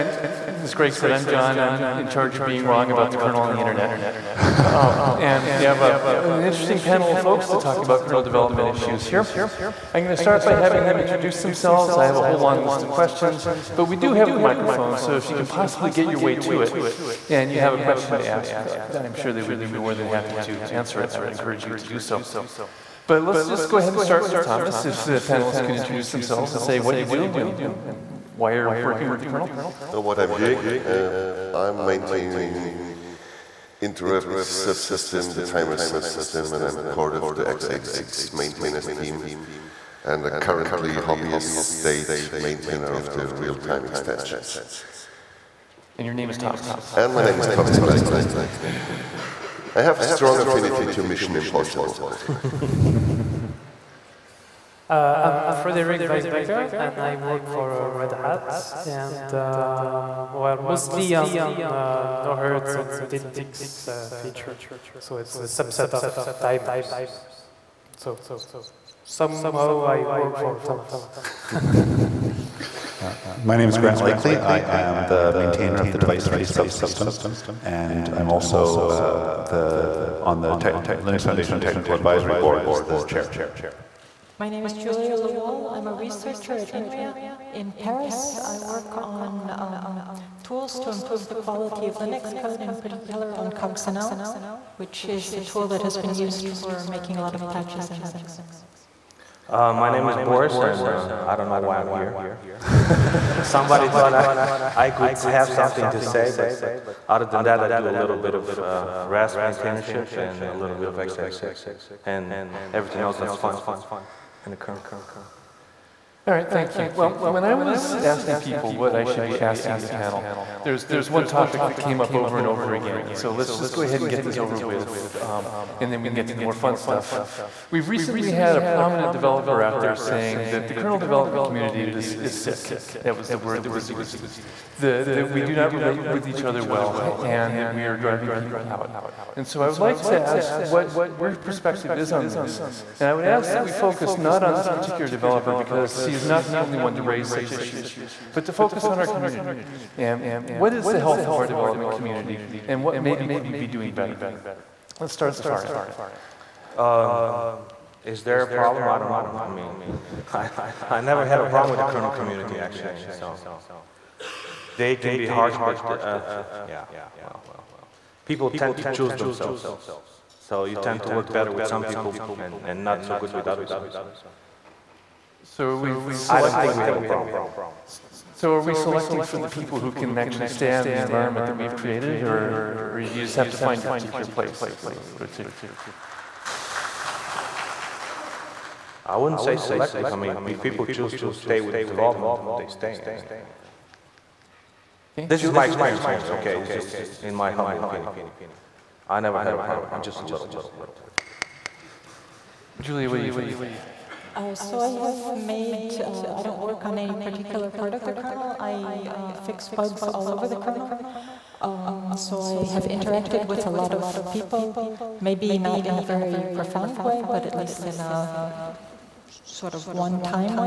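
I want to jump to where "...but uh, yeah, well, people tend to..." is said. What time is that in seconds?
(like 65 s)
165 s.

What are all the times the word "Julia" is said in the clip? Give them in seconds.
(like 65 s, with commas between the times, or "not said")
84 s, 202 s.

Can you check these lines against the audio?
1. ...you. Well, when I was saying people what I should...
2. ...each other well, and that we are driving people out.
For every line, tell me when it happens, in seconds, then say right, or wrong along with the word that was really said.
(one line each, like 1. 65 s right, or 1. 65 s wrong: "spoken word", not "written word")
1. 116 s wrong: "asking", not "saying"
2. 136 s right.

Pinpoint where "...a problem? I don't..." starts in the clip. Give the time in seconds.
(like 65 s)
158 s.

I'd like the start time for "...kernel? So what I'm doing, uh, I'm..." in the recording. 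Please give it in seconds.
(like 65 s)
29 s.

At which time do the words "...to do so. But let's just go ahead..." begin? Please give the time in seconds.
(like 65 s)
21 s.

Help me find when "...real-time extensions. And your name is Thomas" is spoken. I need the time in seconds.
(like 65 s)
43 s.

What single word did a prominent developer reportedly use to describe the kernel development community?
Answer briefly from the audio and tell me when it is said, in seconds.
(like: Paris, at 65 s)
sick, at 132 s.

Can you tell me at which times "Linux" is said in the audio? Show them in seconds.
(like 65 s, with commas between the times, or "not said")
81 s, 91 s, 98 s.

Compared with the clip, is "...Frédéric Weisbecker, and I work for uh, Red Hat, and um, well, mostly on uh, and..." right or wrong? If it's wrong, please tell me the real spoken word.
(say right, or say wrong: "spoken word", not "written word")
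right.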